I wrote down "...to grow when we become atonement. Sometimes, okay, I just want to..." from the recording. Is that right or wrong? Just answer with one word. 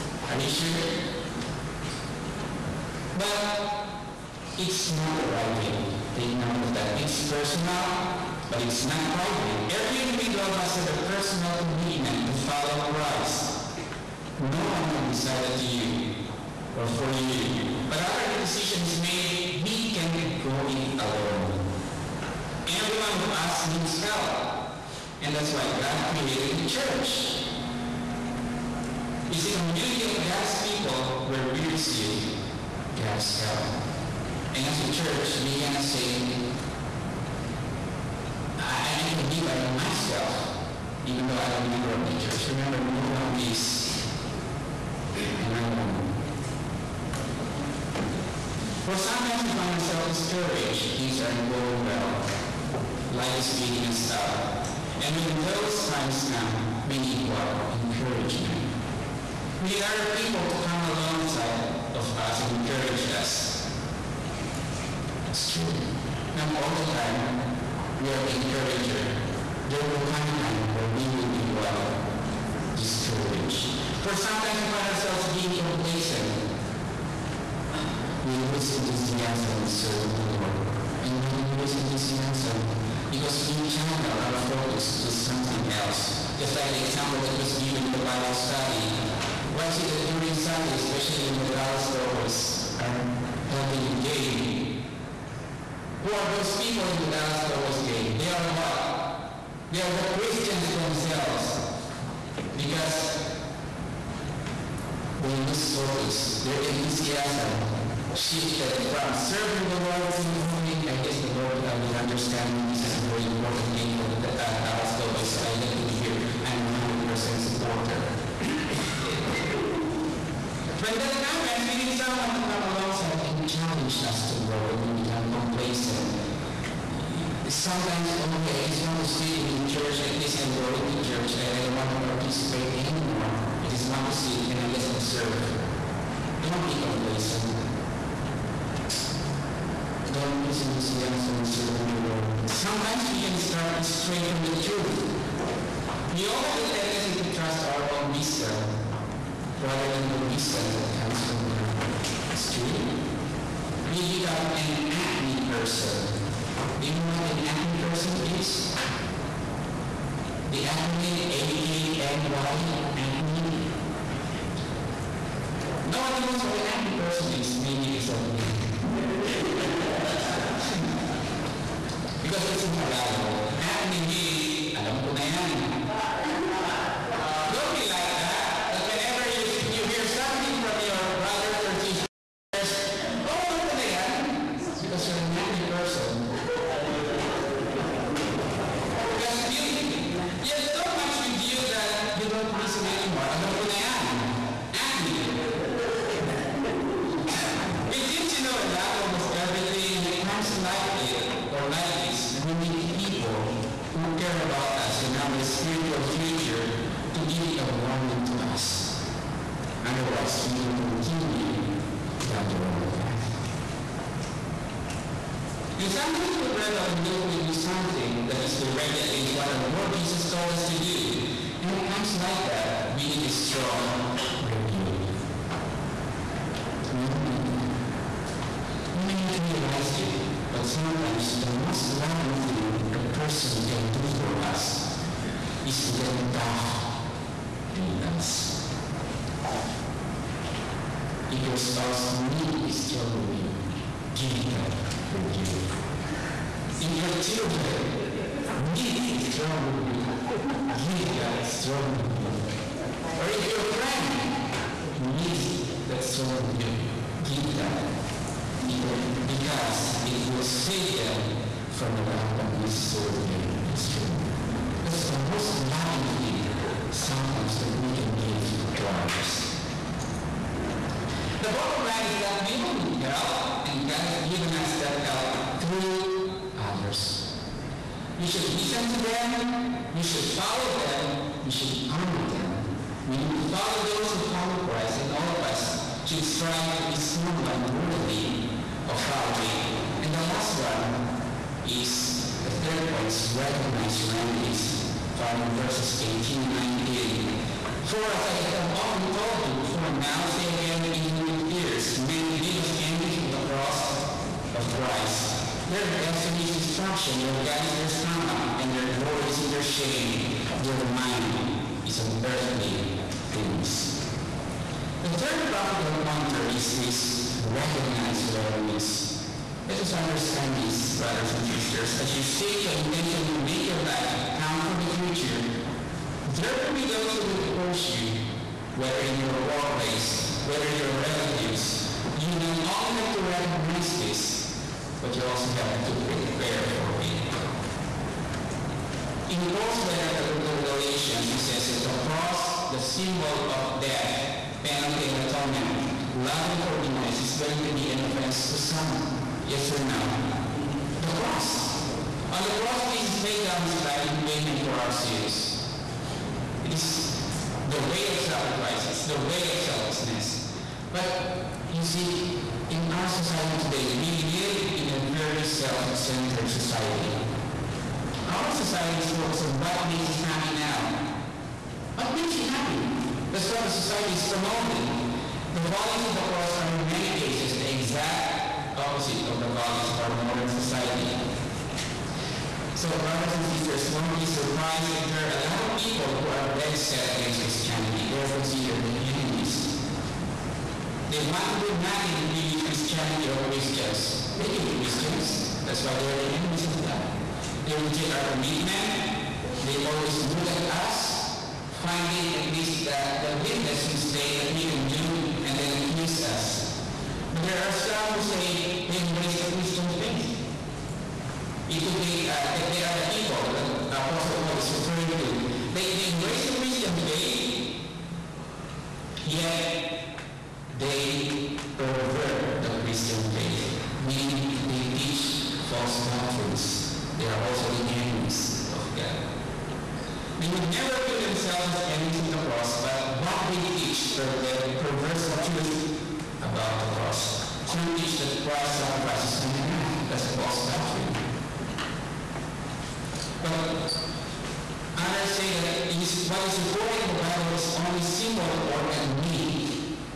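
wrong.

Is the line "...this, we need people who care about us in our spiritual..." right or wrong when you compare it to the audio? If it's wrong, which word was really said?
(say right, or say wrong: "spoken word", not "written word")
right.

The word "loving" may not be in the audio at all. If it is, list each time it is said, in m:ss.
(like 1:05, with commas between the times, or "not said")
3:52, 4:25.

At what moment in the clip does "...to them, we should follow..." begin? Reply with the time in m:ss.
4:38.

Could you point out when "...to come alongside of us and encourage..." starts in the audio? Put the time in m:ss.
1:00.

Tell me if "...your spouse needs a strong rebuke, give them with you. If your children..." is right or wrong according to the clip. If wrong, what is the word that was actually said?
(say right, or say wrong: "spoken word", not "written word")
right.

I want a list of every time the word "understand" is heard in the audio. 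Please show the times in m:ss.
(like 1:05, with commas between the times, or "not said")
1:51, 5:19.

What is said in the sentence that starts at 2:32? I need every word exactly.
It's true we become an acne person.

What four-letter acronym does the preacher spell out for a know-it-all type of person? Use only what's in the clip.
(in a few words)
AKNY.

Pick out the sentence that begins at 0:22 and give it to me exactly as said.
Every one of us needs help.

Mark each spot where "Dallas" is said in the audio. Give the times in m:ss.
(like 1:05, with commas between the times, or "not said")
1:31, 1:37, 1:54.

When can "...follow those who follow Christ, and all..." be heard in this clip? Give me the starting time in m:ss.
4:43.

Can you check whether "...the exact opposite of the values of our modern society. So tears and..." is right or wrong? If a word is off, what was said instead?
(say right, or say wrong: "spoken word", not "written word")
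wrong: "brothers", not "tears".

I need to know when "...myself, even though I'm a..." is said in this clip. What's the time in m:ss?
0:39.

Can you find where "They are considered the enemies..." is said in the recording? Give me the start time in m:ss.
6:28.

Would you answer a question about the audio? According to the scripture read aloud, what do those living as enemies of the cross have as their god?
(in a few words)
their stomach.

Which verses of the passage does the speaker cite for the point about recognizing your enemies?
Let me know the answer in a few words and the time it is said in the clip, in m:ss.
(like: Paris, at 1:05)
verses 18 and 19, at 4:55.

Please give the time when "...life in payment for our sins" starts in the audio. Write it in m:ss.
5:53.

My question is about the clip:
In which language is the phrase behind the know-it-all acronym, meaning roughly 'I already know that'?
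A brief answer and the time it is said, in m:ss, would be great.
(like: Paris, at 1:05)
Tagalog, at 2:52.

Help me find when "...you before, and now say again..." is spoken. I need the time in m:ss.
4:59.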